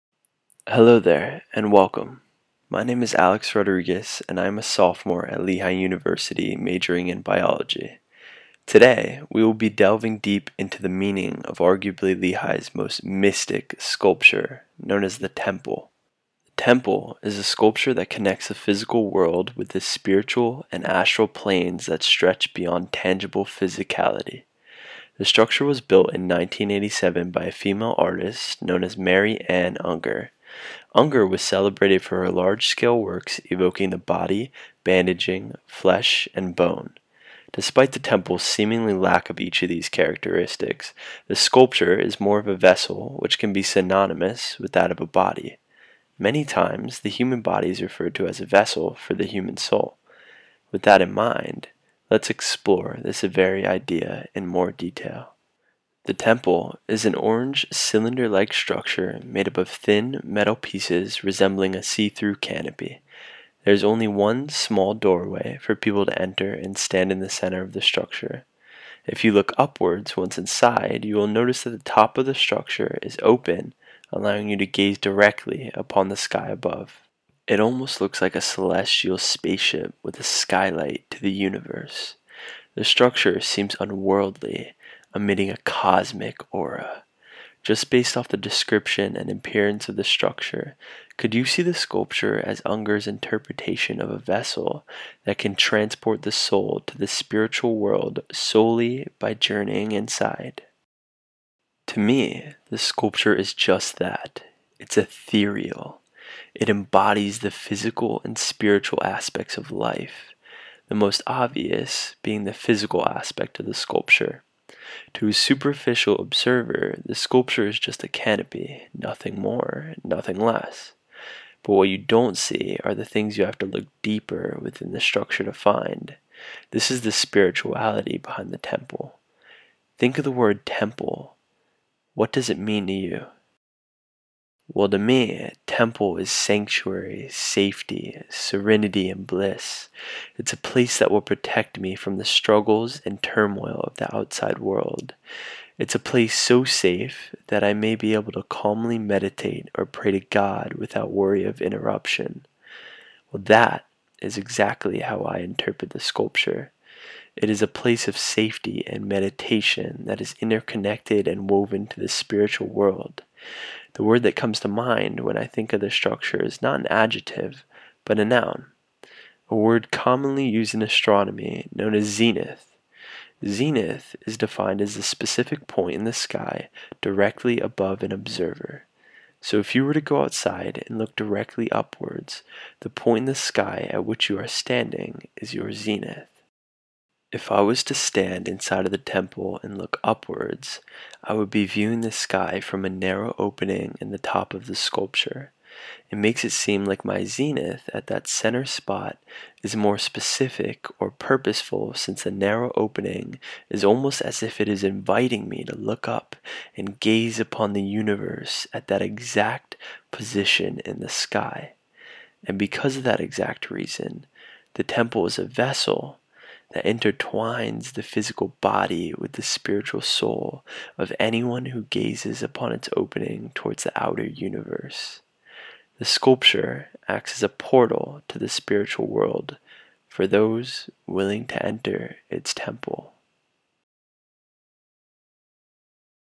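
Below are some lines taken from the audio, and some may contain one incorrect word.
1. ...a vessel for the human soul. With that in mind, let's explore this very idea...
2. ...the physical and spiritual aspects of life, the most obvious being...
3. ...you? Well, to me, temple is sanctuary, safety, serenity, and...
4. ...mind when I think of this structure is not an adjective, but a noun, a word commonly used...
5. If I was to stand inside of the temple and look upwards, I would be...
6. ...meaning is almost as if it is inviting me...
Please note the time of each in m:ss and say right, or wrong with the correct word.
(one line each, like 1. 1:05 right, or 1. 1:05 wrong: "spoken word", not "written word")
1. 0:48 right
2. 1:47 right
3. 2:12 right
4. 2:44 right
5. 3:07 right
6. 3:22 wrong: "opening", not "meaning".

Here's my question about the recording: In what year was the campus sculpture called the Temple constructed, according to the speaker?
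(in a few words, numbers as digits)
1987.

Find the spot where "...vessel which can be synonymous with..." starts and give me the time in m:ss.
0:42.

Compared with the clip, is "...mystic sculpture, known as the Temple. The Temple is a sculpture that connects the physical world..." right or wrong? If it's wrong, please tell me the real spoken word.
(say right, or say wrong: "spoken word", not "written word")
right.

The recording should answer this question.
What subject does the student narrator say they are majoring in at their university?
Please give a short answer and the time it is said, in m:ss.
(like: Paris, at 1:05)
Biology, at 0:07.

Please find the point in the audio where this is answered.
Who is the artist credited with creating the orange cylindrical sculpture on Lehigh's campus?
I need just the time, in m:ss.
0:28.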